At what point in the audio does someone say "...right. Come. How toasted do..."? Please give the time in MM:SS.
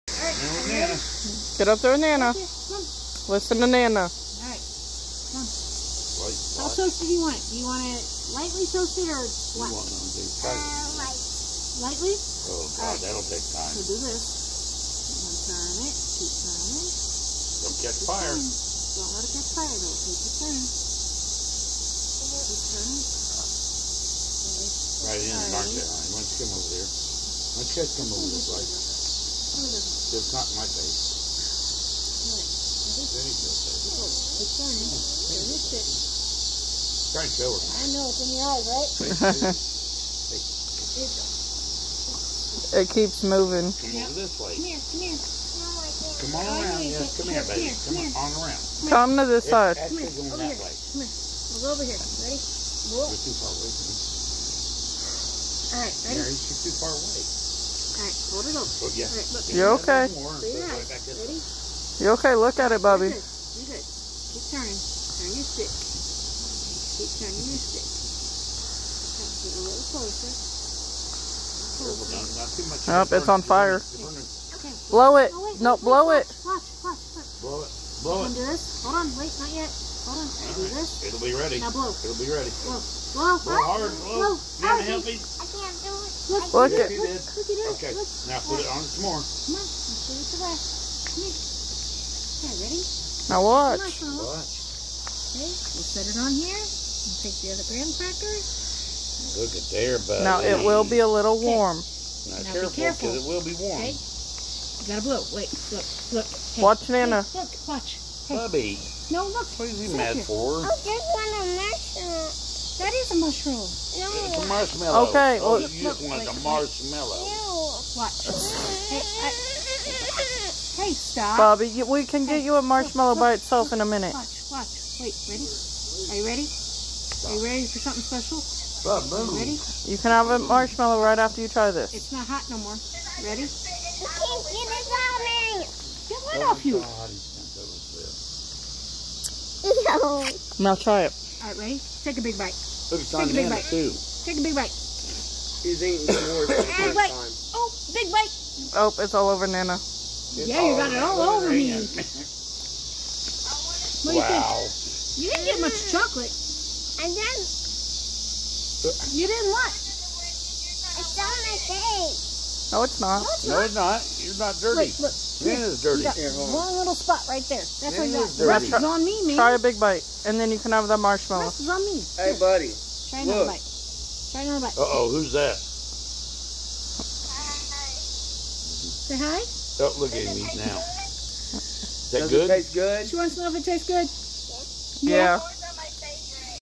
00:04.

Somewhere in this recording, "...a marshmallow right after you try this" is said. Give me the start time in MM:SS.
02:10.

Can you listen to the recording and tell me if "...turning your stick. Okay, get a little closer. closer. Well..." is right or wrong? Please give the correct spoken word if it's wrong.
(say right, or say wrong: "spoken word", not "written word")
right.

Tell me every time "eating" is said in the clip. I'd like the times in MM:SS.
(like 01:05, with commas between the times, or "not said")
02:25, 03:00.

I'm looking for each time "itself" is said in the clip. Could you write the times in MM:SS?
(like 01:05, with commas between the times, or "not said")
02:03.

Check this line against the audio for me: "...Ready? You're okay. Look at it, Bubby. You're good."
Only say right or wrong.
right.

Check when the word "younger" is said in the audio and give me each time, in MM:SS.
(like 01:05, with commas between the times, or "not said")
not said.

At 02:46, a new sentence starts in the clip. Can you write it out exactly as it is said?
You Here, one little spot right there.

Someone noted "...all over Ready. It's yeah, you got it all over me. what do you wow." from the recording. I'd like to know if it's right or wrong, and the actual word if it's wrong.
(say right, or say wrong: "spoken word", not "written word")
wrong: "Nana", not "Ready".